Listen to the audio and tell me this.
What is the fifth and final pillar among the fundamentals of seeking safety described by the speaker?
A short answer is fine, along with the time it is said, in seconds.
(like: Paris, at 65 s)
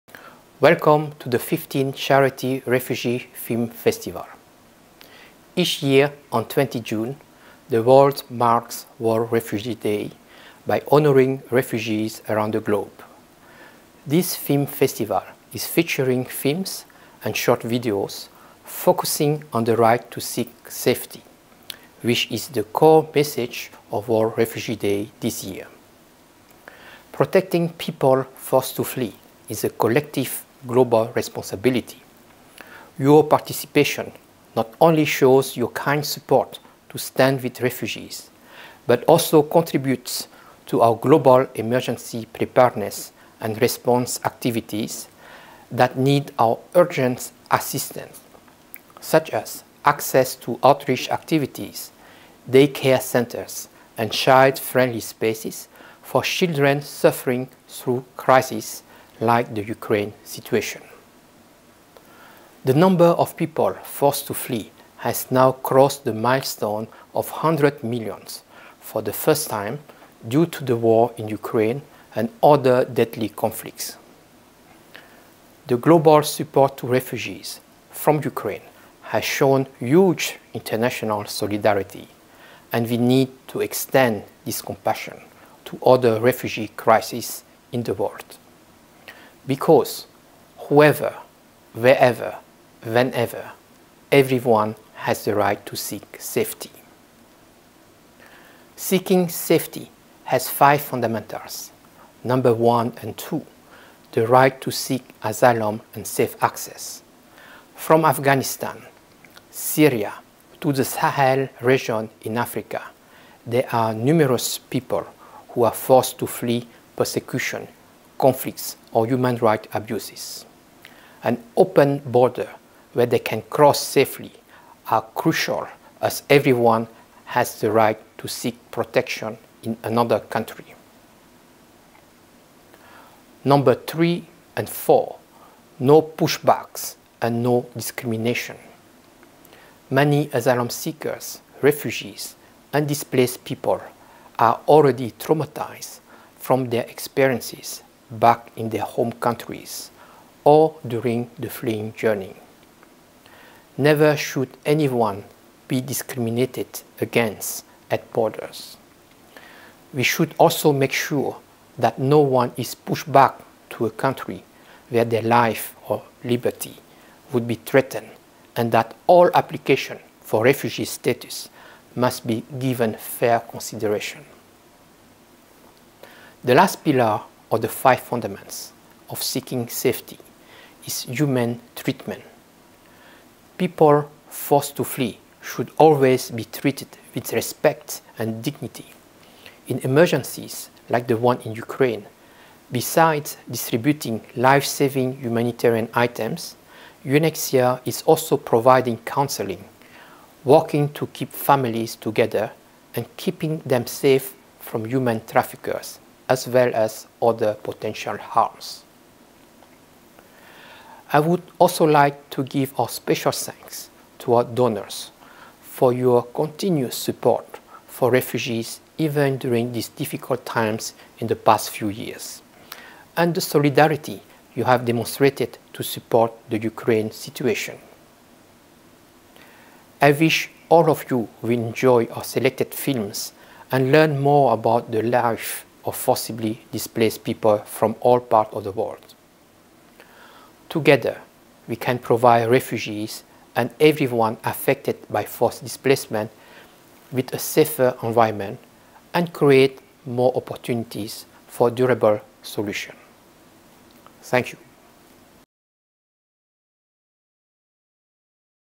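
Human treatment, at 181 s.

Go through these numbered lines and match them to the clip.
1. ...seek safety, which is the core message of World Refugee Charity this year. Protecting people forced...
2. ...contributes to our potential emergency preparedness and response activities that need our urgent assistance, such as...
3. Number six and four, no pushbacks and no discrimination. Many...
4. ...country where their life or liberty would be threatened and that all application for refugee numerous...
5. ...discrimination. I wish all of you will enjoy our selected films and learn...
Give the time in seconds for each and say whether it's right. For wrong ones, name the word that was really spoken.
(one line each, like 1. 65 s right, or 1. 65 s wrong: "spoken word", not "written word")
1. 20 s wrong: "Day", not "Charity"
2. 39 s wrong: "global", not "potential"
3. 133 s wrong: "three", not "six"
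4. 163 s wrong: "status", not "numerous"
5. 227 s wrong: "situation", not "discrimination".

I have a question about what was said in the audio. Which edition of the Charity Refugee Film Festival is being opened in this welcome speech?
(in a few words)
15th.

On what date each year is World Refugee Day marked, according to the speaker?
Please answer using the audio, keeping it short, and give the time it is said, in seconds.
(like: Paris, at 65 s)
20 June, at 6 s.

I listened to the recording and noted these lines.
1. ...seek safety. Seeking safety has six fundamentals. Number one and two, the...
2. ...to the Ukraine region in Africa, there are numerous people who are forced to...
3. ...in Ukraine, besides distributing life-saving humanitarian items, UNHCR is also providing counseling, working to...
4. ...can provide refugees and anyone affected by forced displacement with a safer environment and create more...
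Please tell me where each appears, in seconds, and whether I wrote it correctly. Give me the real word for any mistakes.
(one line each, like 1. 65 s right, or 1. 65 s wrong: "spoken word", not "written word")
1. 95 s wrong: "five", not "six"
2. 110 s wrong: "Sahel", not "Ukraine"
3. 191 s right
4. 241 s wrong: "everyone", not "anyone".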